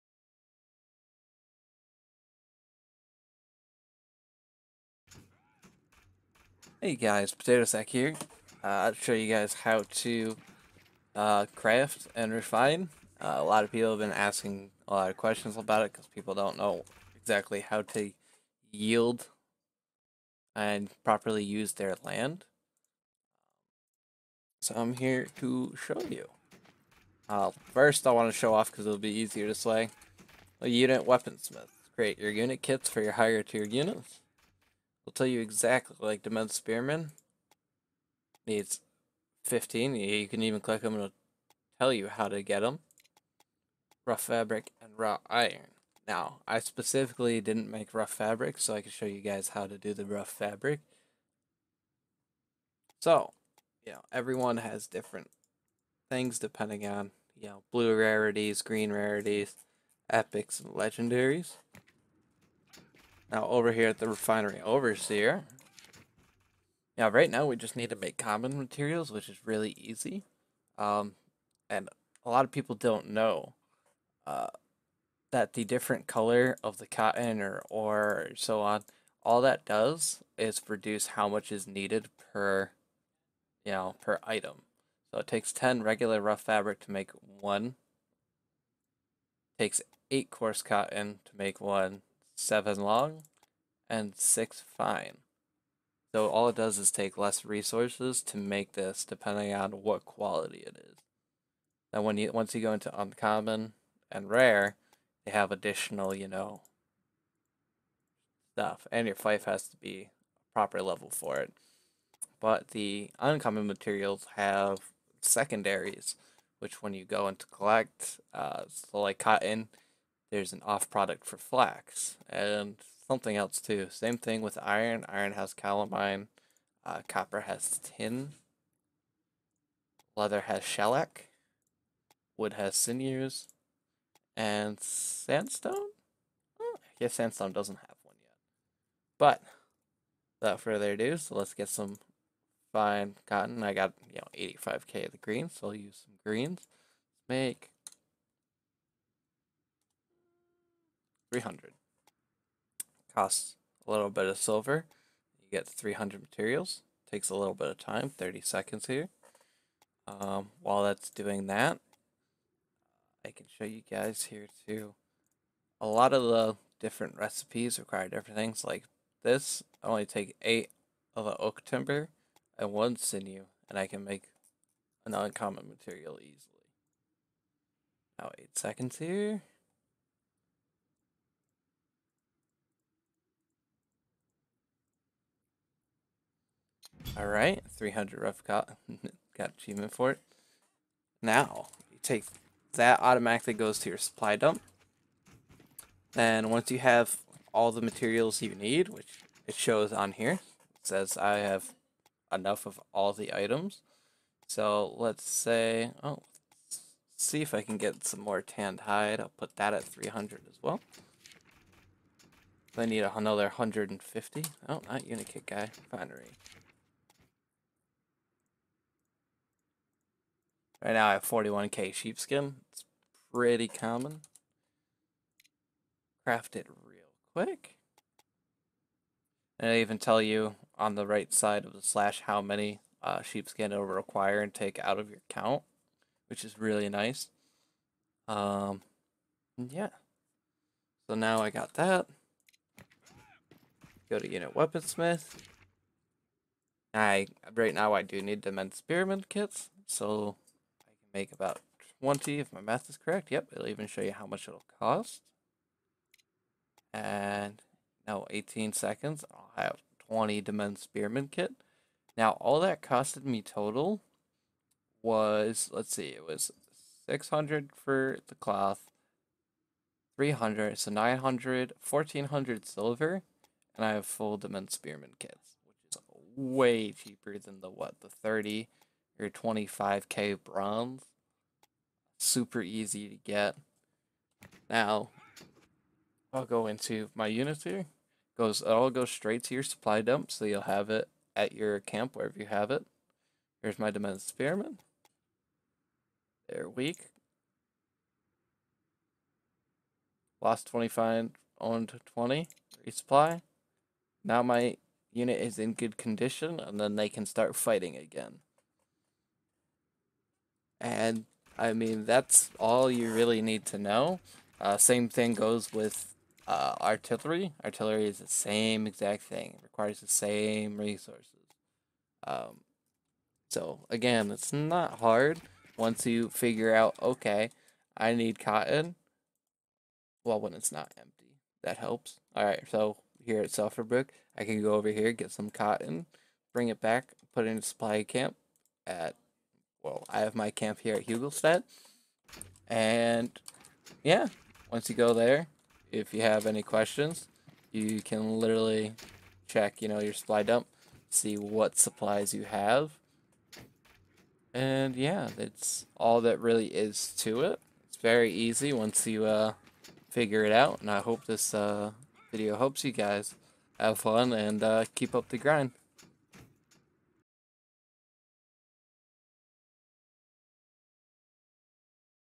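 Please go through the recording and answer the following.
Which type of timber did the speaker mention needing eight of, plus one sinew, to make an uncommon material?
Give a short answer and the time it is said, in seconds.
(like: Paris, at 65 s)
Oak timber, at 171 s.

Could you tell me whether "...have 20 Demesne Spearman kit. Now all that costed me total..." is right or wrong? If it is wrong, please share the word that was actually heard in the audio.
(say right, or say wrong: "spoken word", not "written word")
right.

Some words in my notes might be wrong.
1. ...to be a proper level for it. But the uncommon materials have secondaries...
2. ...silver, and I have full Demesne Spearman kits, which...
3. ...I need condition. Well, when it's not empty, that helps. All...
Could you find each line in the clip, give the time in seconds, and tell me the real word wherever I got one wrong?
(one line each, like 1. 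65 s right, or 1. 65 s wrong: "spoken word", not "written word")
1. 109 s right
2. 272 s right
3. 327 s wrong: "cotton", not "condition".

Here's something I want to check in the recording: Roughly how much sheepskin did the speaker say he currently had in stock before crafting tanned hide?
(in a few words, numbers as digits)
41k.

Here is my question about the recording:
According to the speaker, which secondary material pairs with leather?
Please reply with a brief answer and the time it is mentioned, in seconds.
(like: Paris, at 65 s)
Shellac, at 130 s.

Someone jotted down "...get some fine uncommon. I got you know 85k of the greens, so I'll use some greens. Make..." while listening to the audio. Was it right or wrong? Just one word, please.
wrong.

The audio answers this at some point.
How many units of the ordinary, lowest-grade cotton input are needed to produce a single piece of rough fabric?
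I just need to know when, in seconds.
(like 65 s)
85 s.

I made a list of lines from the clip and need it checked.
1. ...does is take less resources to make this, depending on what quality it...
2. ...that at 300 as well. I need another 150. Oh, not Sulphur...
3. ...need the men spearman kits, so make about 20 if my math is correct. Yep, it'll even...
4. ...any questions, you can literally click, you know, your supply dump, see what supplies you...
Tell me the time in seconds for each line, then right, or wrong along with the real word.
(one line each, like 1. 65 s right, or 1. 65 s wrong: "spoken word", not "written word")
1. 96 s right
2. 209 s wrong: "Unikit", not "Sulphur"
3. 248 s right
4. 346 s wrong: "check", not "click".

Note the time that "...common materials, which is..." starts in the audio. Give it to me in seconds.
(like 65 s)
68 s.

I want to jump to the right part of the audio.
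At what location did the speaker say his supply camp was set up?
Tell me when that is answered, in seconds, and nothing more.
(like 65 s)
341 s.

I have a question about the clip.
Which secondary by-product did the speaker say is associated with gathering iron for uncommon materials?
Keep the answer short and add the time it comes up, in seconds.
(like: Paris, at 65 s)
Calamine, at 125 s.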